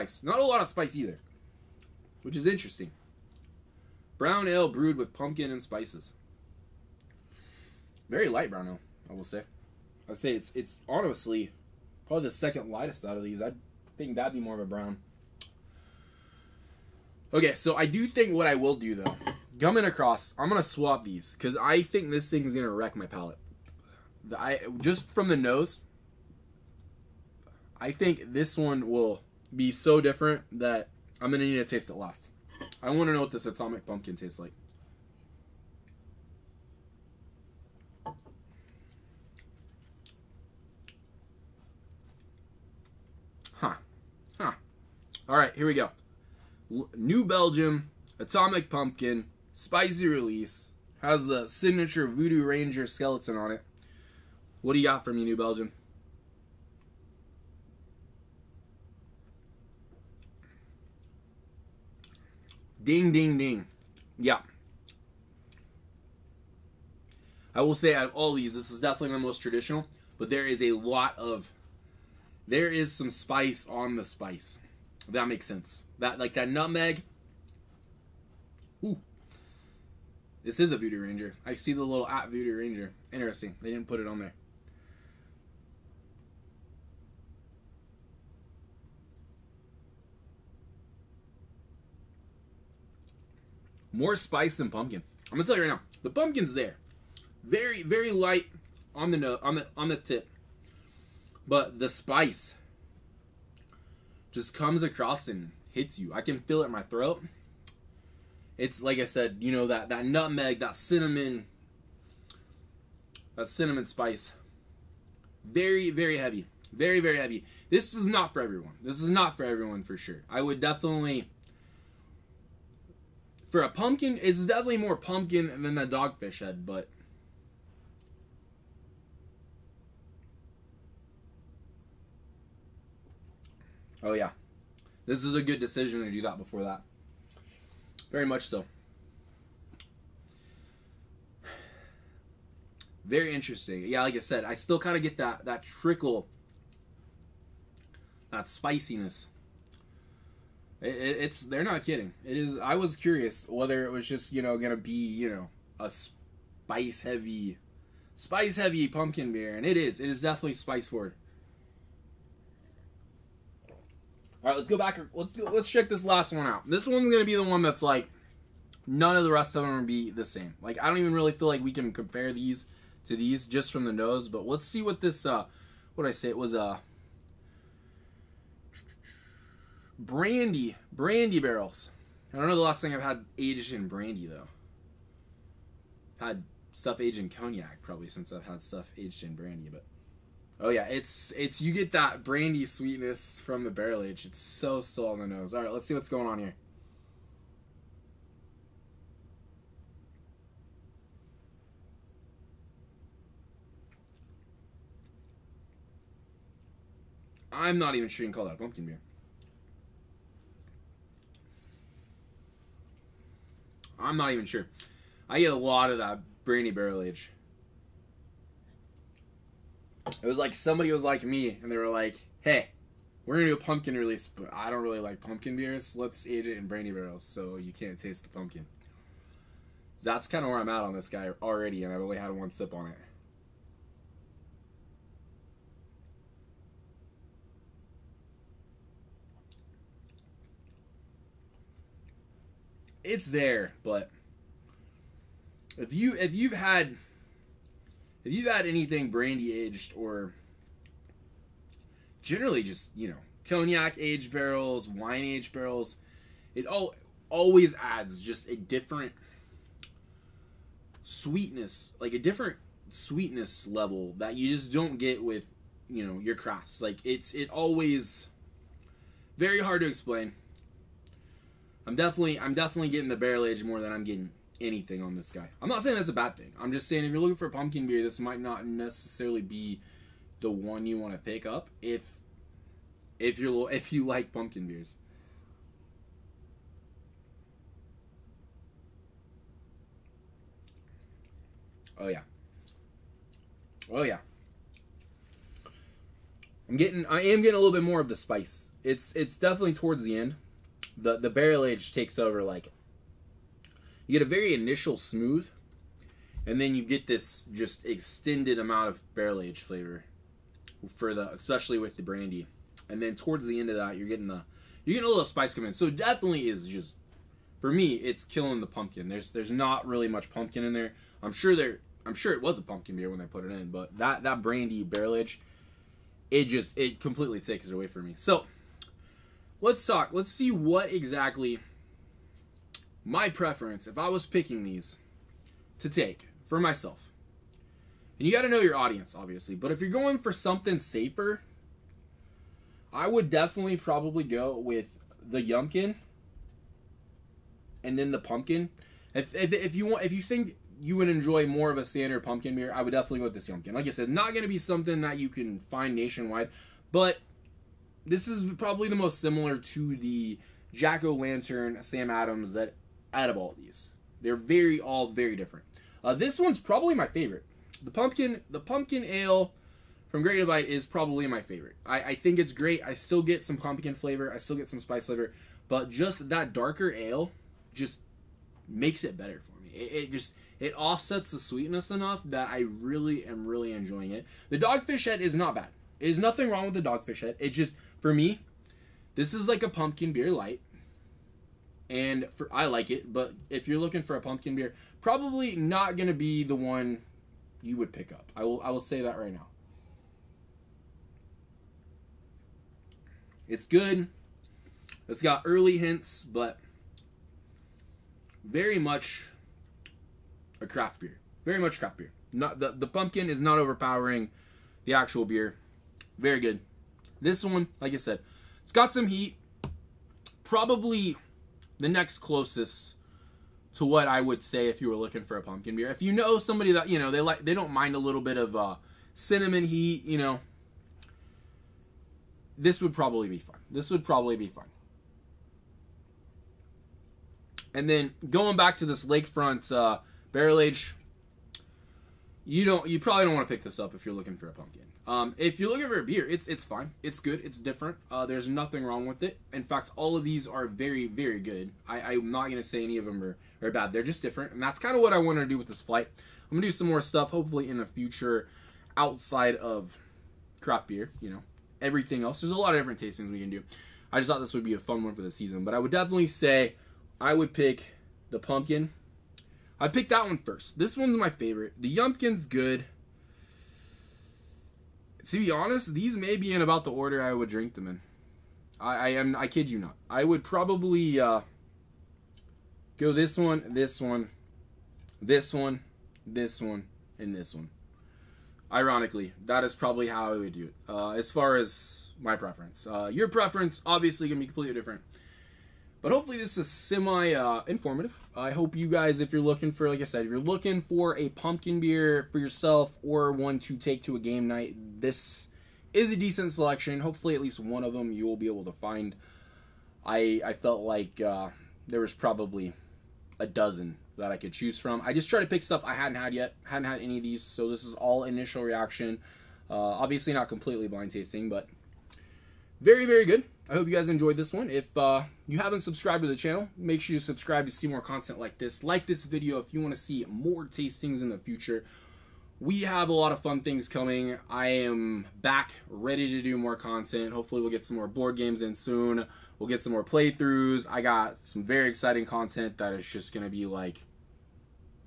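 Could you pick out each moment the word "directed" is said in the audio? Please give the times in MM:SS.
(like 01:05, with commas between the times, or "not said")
not said.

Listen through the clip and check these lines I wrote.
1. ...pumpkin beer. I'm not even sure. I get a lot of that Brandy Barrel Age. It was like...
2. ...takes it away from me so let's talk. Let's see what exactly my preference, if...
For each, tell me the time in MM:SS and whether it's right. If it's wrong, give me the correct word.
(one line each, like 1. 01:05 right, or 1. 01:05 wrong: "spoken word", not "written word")
1. 03:28 right
2. 05:27 right.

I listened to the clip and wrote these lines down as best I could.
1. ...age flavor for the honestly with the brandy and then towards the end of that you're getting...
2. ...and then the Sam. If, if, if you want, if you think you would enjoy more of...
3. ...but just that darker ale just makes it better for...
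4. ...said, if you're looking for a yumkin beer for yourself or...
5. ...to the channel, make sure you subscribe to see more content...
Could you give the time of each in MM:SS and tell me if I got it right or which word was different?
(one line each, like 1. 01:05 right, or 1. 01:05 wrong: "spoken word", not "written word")
1. 05:09 wrong: "especially", not "honestly"
2. 05:47 wrong: "Pumpkin", not "Sam"
3. 06:15 right
4. 08:20 wrong: "pumpkin", not "yumkin"
5. 08:46 right.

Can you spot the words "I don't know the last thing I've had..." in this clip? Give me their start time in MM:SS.
03:02.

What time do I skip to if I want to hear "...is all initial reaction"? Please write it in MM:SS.
08:37.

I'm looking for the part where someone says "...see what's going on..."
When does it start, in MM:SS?
03:15.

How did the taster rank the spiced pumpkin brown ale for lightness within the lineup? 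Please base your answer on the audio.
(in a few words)
Second lightest.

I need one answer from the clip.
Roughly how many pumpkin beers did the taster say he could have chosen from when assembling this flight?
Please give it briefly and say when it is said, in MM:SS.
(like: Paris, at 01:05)
12, at 08:33.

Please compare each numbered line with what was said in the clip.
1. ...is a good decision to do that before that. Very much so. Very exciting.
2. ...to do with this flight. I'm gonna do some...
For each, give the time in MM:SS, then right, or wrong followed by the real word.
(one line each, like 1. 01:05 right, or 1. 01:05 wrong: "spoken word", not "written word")
1. 02:15 wrong: "interesting", not "exciting"
2. 07:35 right.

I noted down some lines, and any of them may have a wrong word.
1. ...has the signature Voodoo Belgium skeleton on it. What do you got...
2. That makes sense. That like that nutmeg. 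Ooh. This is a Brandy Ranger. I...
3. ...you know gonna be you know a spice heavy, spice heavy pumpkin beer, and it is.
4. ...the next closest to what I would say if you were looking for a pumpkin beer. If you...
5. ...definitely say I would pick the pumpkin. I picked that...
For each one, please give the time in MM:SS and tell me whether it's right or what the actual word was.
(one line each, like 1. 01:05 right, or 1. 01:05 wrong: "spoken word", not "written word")
1. 00:51 wrong: "Ranger", not "Belgium"
2. 01:15 wrong: "Voodoo", not "Brandy"
3. 02:34 right
4. 07:01 right
5. 07:45 right.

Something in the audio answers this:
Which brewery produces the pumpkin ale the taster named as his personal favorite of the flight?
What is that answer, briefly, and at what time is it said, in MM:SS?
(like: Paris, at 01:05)
Great Divide, at 06:10.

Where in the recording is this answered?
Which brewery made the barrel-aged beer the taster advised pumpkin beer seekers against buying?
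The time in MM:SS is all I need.
07:19.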